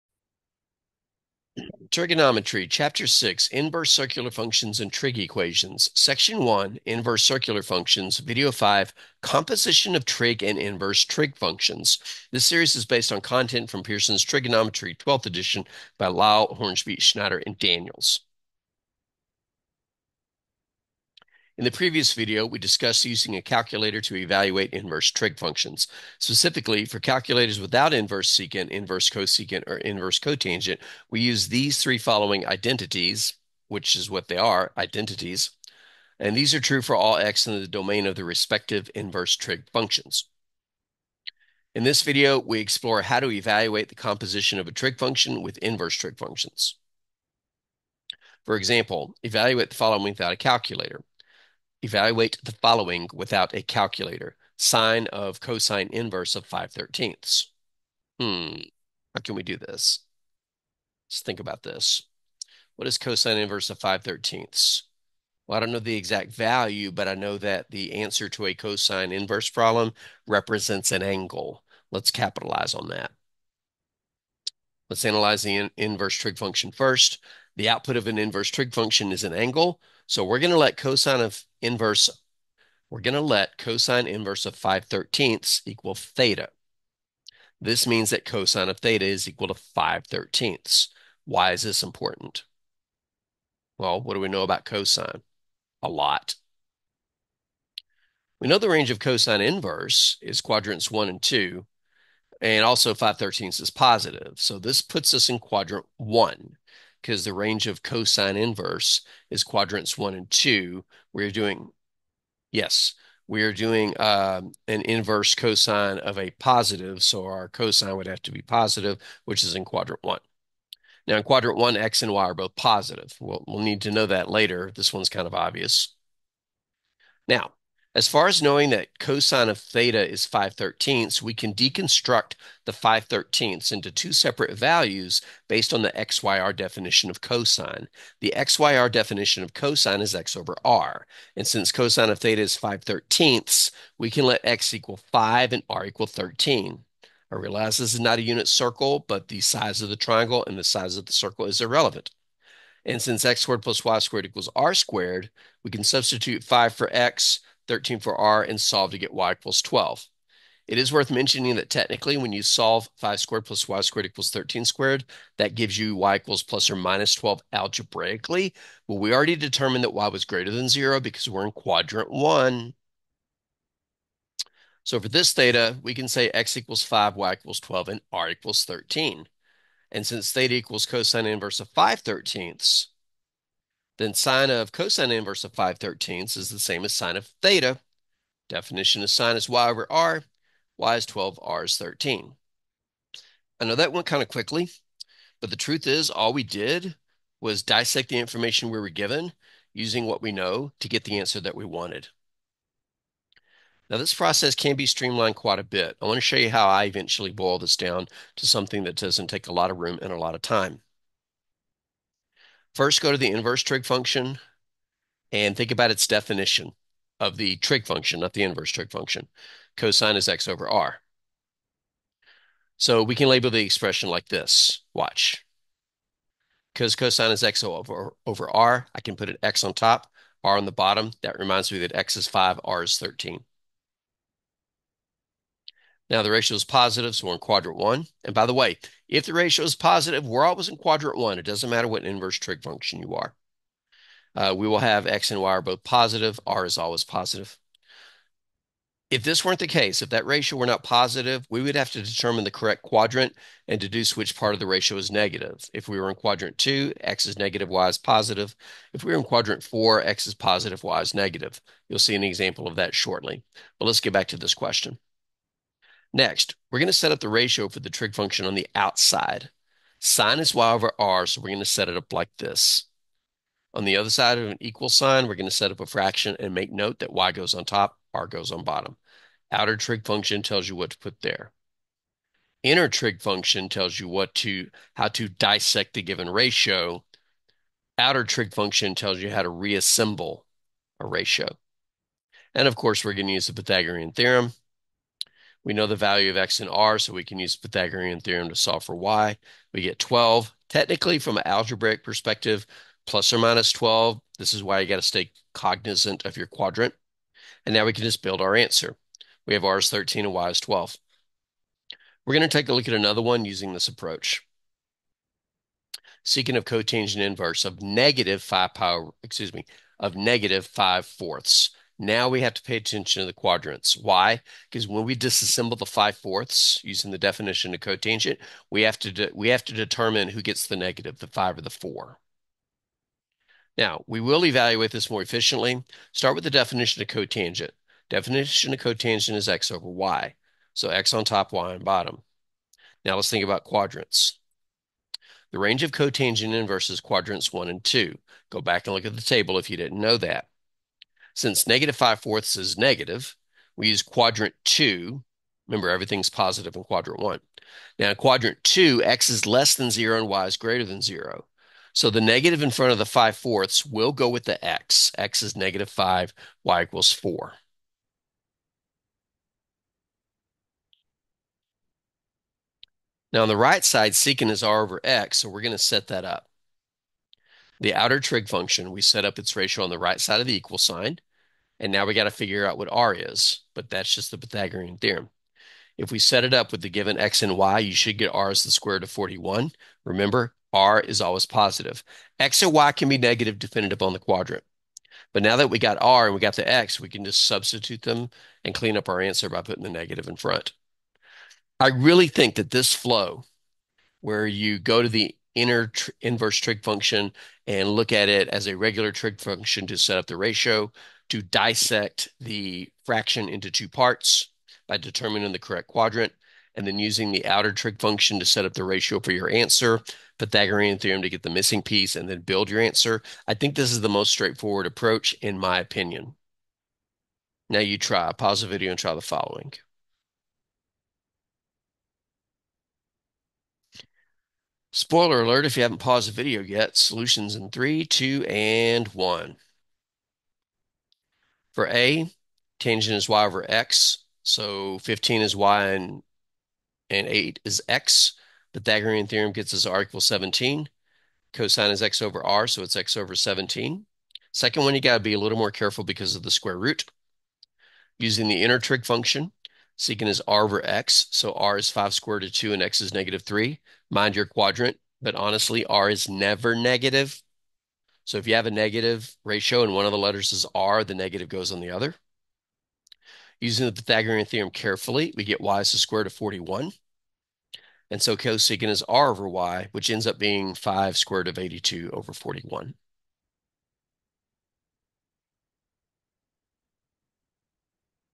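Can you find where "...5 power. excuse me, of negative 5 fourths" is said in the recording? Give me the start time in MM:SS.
05:18.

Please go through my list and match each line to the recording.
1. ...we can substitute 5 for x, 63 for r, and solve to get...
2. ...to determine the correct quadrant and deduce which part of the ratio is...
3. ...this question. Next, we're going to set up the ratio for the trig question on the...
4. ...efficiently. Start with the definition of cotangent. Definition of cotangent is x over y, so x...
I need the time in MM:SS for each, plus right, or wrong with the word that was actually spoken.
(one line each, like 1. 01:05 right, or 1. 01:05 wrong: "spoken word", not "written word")
1. 02:35 wrong: "13", not "63"
2. 04:11 right
3. 04:24 wrong: "function", not "question"
4. 05:35 right.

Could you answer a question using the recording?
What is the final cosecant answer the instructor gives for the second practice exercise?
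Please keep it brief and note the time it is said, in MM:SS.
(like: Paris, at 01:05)
5√82/41, at 08:00.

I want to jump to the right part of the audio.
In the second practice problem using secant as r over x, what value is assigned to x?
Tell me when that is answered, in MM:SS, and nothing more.
07:43.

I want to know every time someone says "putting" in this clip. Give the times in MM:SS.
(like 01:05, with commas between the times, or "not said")
06:39.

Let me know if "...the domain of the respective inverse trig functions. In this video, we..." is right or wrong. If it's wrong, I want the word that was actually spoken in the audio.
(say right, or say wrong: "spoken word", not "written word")
right.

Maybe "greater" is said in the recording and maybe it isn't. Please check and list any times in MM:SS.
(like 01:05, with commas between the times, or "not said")
02:50, 06:00.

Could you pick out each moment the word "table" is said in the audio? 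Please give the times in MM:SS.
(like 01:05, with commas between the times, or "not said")
05:49.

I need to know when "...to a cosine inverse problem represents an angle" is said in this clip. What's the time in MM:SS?
01:08.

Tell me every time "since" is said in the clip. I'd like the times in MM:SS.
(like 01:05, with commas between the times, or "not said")
02:21, 02:33, 03:00, 05:51.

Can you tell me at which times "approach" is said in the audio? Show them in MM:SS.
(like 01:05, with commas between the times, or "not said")
05:13, 07:04.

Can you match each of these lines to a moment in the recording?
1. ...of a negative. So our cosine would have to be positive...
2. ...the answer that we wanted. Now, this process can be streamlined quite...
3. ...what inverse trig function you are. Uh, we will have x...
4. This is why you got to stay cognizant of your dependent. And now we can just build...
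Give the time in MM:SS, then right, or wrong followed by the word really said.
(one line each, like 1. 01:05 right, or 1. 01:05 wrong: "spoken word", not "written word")
1. 01:55 wrong: "positive", not "negative"
2. 03:21 right
3. 04:01 right
4. 05:04 wrong: "quadrant", not "dependent".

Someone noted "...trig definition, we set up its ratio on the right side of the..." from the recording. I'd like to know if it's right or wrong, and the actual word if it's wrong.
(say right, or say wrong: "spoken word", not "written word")
wrong: "function", not "definition".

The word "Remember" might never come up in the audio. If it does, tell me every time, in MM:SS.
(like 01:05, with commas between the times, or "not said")
05:55, 06:30.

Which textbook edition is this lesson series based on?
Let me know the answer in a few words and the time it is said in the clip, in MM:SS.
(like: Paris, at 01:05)
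12th edition, at 00:14.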